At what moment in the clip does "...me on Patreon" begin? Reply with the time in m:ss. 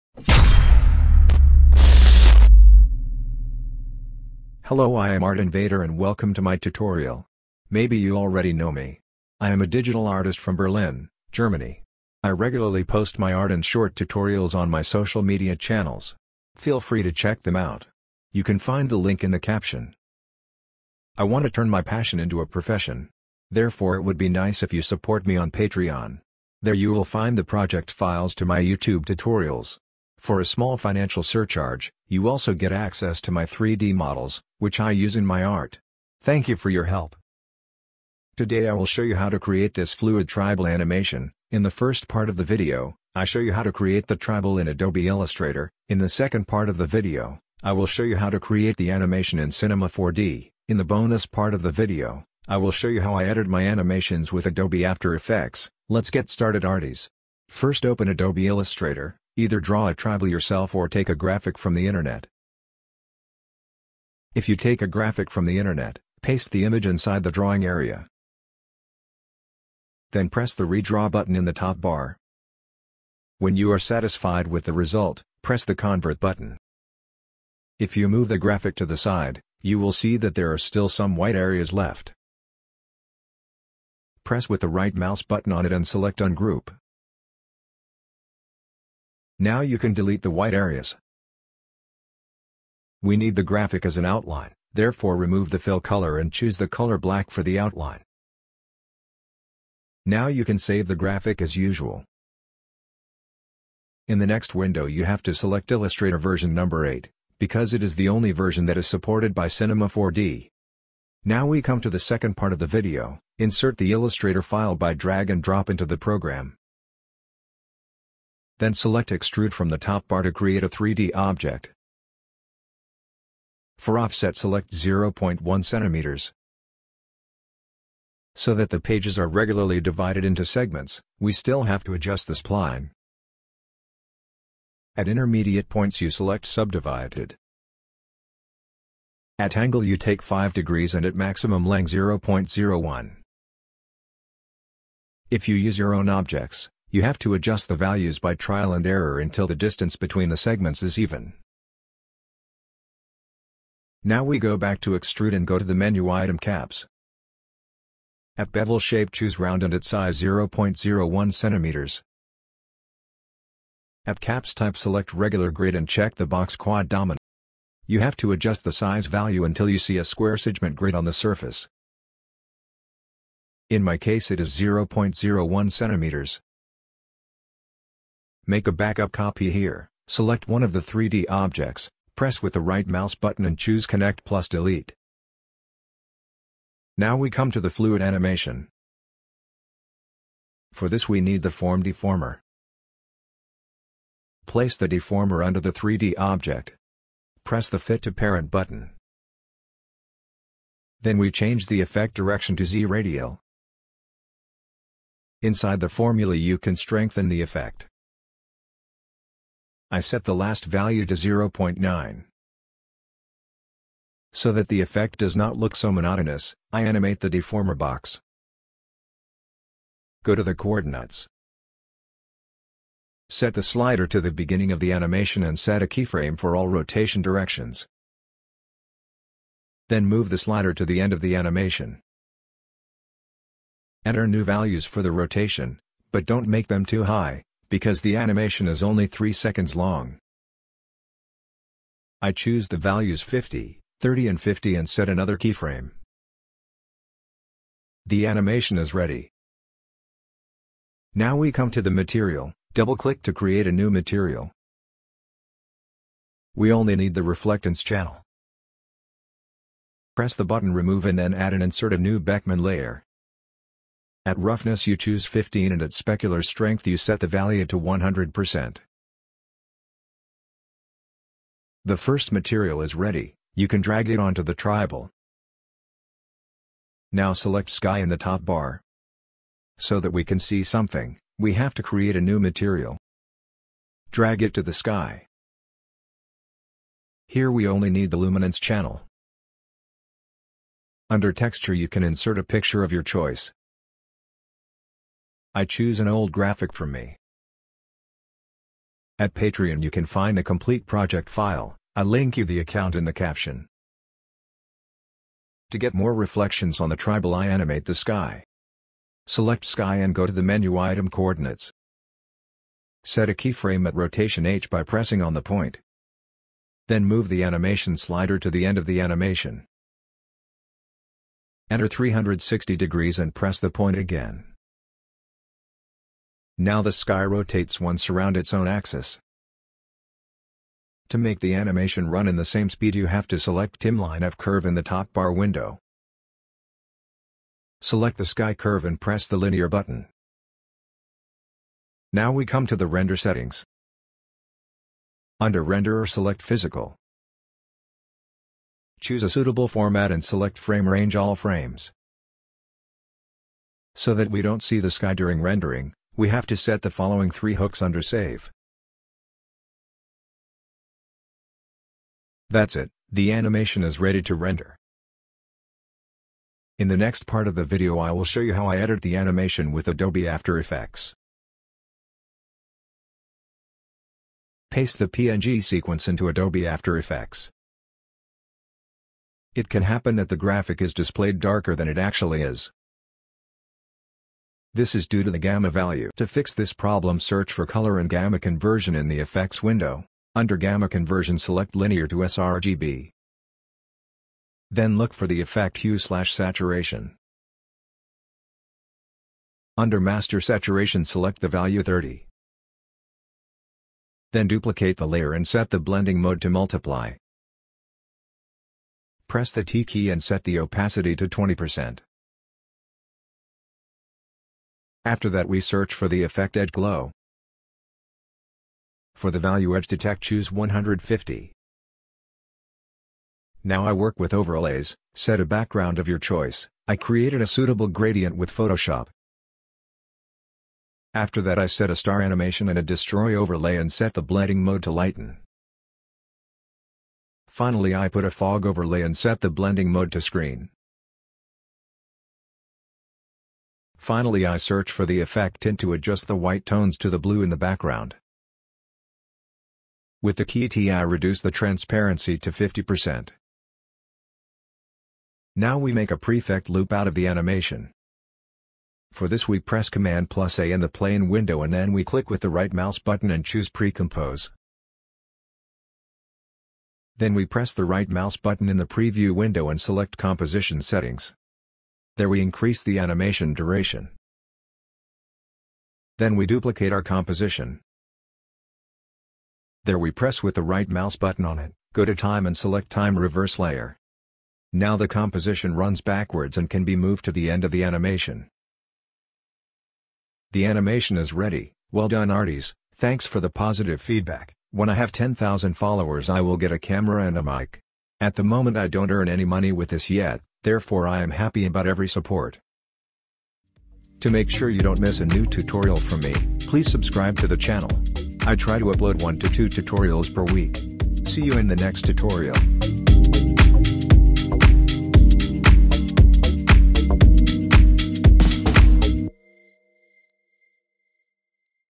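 0:25.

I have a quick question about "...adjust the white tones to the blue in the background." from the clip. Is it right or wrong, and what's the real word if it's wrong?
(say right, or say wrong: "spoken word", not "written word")
right.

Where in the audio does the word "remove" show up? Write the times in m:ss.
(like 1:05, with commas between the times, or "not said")
1:35, 4:20.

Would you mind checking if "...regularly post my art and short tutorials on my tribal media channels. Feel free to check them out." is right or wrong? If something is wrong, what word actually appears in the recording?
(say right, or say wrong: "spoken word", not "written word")
wrong: "social", not "tribal".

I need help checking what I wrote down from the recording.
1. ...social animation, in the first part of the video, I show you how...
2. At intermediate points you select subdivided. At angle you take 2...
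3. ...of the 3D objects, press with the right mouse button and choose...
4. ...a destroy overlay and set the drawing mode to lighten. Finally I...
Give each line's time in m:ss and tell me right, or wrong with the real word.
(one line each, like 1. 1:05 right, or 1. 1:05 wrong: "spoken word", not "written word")
1. 0:40 wrong: "tribal", not "social"
2. 2:14 wrong: "5", not "2"
3. 3:00 right
4. 7:12 wrong: "blending", not "drawing".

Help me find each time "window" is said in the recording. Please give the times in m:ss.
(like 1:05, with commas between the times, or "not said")
1:44, 5:35, 6:29, 7:41, 7:49.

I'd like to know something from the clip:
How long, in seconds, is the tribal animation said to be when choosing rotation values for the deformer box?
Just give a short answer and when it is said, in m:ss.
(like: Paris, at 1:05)
3, at 3:59.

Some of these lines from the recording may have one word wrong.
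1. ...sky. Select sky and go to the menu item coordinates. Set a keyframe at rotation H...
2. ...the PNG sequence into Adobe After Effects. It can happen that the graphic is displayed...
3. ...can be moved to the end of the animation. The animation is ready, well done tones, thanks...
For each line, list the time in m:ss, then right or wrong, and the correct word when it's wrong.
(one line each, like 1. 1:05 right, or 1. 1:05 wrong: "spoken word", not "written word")
1. 5:07 right
2. 6:14 right
3. 8:06 wrong: "arties", not "tones".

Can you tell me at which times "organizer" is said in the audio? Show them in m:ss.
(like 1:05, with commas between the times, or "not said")
not said.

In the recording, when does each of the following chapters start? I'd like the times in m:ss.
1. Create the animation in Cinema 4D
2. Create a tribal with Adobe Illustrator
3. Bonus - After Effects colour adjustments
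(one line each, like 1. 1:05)
1. 1:52
2. 0:57
3. 6:12.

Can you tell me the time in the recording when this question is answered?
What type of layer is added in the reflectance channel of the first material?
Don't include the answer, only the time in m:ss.
4:22.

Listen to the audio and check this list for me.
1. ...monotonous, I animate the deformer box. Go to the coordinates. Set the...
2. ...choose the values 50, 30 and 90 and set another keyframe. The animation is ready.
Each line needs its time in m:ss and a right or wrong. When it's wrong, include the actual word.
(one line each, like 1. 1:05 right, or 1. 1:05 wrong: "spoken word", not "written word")
1. 3:35 right
2. 4:02 wrong: "50", not "90".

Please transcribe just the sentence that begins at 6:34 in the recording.
Then look for the effect hue slash saturation.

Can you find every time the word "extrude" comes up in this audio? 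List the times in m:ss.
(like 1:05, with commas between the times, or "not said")
1:59, 2:34.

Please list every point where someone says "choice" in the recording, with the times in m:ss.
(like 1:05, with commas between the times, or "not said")
4:53, 7:06.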